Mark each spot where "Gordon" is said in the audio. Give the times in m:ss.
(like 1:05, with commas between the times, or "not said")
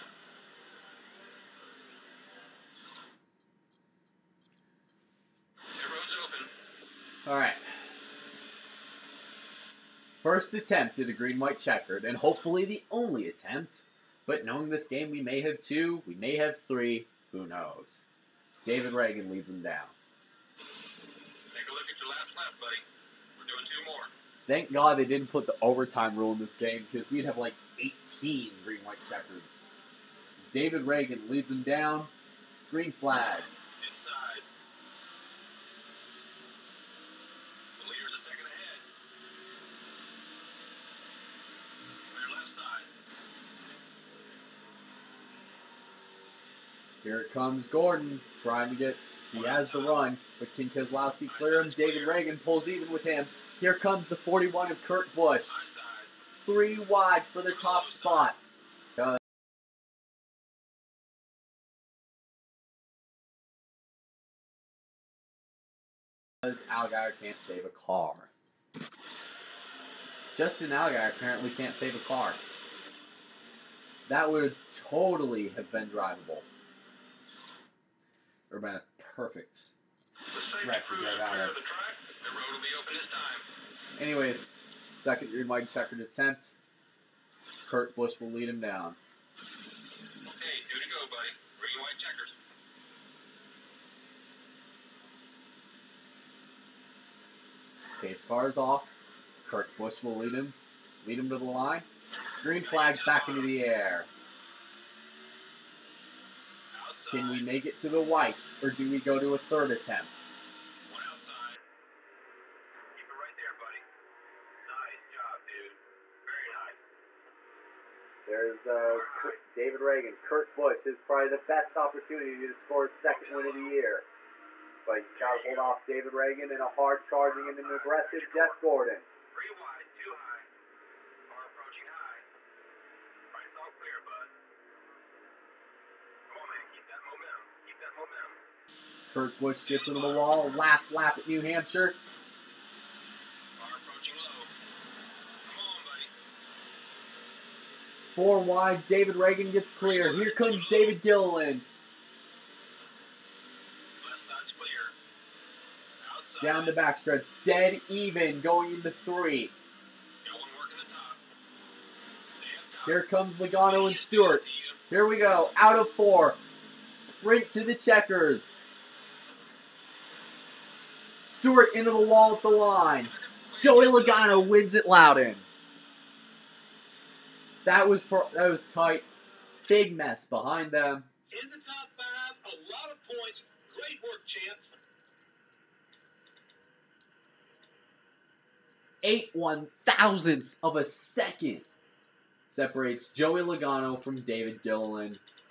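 0:47, 2:08.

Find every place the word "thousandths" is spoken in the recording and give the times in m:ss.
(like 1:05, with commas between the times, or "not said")
3:09.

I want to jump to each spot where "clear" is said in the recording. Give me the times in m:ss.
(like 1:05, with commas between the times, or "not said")
0:51, 2:29.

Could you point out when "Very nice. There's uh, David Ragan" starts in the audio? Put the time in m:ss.
1:58.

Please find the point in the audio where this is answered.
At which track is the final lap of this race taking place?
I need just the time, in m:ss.
2:21.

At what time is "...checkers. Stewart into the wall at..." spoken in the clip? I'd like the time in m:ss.
2:47.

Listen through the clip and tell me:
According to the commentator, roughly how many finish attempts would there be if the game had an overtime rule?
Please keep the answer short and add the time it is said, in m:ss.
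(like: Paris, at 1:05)
18, at 0:27.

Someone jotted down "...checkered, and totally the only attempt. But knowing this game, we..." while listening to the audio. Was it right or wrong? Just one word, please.
wrong.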